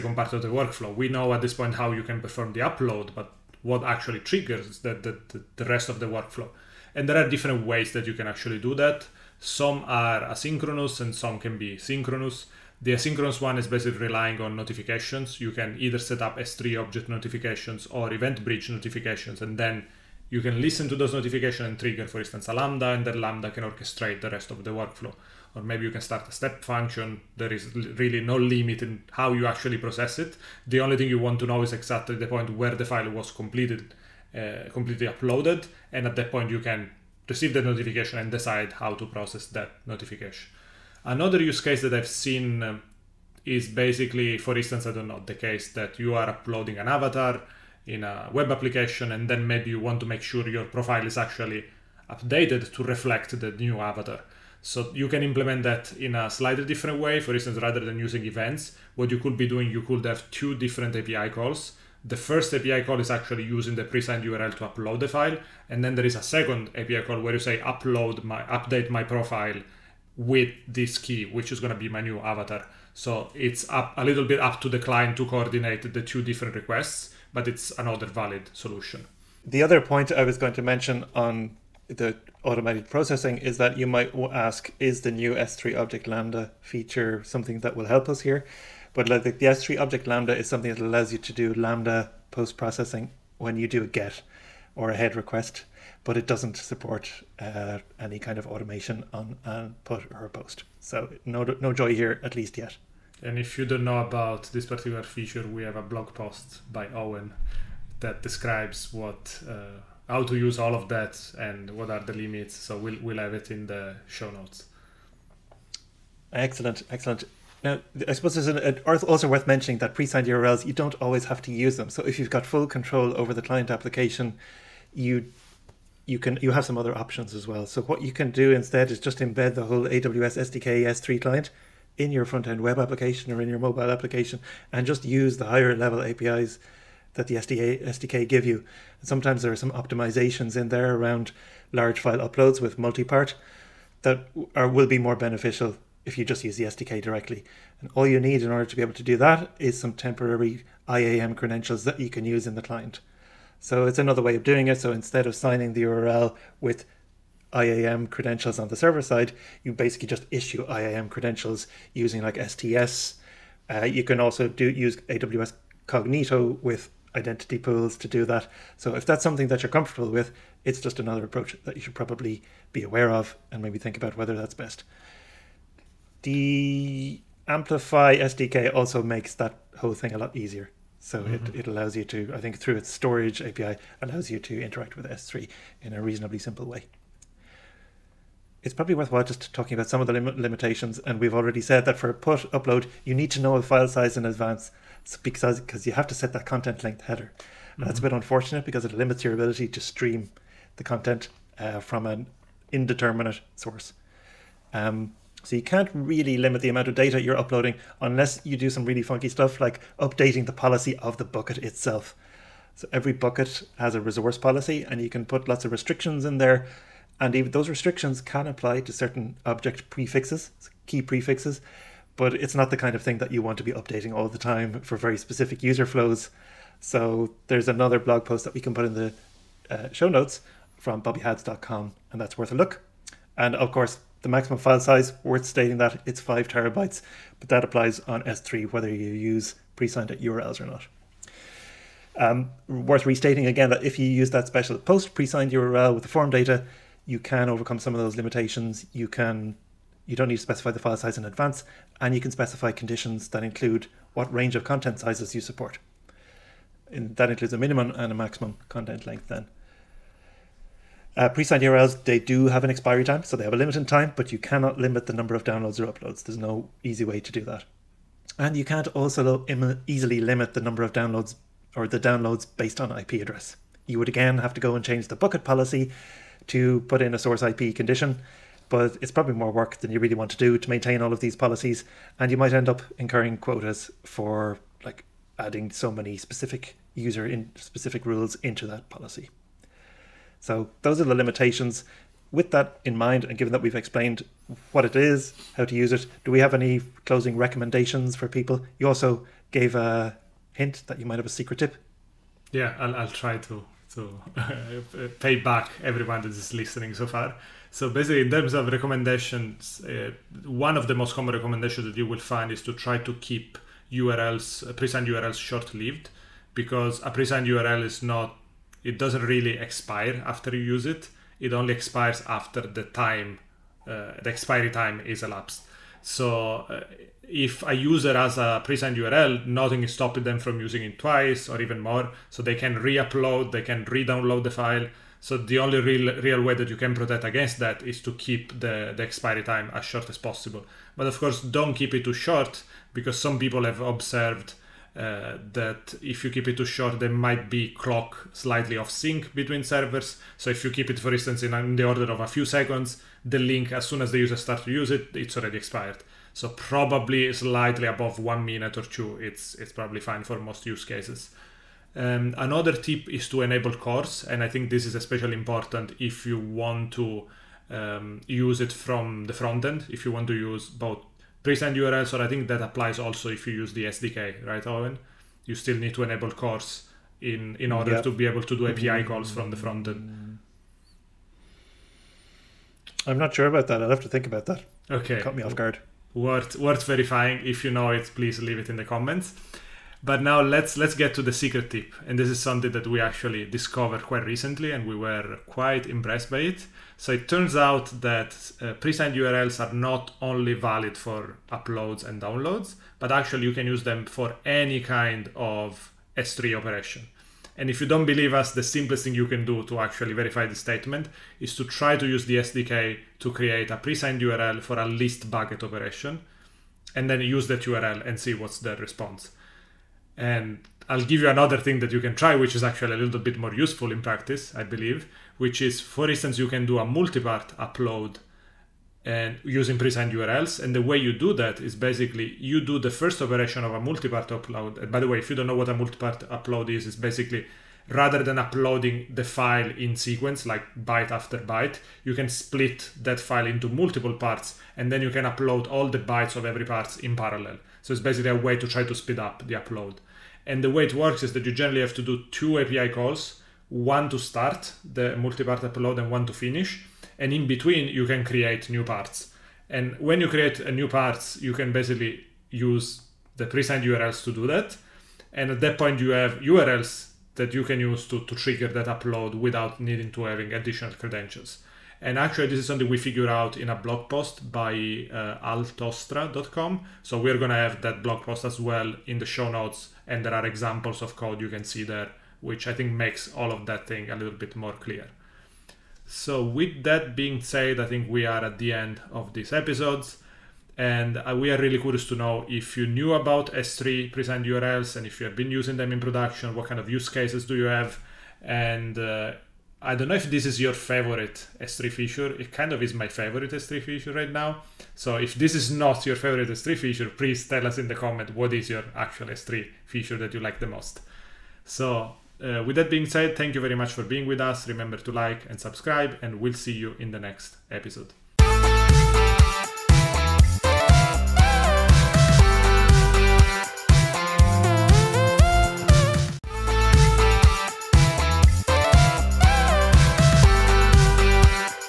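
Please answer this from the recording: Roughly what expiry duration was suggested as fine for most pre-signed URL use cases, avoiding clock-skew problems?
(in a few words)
1 or 2 minutes.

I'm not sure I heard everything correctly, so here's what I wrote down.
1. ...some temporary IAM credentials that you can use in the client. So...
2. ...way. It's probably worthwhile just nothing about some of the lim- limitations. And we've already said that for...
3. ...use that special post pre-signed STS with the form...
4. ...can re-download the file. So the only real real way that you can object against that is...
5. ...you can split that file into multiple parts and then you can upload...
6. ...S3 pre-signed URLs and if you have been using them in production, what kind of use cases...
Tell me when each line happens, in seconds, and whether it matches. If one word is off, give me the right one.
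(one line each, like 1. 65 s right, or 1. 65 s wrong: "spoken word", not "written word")
1. 149 s right
2. 186 s wrong: "talking", not "nothing"
3. 244 s wrong: "URL", not "STS"
4. 333 s wrong: "protect", not "object"
5. 442 s right
6. 493 s right.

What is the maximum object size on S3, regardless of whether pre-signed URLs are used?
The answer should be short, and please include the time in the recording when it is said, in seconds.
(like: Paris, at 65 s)
5 terabytes, at 236 s.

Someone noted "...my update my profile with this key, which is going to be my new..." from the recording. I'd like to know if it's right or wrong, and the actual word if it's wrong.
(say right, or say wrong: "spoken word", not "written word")
right.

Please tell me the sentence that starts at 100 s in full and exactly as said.
So no, no joy here, at least yet.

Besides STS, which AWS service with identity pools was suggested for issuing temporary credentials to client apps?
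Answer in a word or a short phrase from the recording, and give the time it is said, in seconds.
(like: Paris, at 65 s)
AWS Cognito, at 165 s.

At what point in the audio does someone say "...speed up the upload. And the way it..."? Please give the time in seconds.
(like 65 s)
448 s.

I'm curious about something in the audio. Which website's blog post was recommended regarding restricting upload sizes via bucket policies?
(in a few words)
bobbyhadz.com.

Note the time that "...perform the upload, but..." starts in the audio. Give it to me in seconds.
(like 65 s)
2 s.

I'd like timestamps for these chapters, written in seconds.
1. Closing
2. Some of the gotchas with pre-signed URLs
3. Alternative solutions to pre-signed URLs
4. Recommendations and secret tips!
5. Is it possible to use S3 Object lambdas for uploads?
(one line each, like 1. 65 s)
1. 490 s
2. 187 s
3. 121 s
4. 304 s
5. 81 s.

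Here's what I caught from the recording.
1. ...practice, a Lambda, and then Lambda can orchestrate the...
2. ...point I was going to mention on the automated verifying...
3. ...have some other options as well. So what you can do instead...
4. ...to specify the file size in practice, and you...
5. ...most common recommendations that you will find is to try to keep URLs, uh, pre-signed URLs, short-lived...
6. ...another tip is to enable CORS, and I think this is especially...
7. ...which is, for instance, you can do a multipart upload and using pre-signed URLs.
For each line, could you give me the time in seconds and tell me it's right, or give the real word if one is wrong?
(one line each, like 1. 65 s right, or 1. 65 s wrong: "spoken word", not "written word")
1. 22 s wrong: "instance", not "practice"
2. 79 s wrong: "processing", not "verifying"
3. 126 s right
4. 250 s wrong: "advance", not "practice"
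5. 310 s right
6. 362 s right
7. 425 s right.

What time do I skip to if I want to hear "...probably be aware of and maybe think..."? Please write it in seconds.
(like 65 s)
171 s.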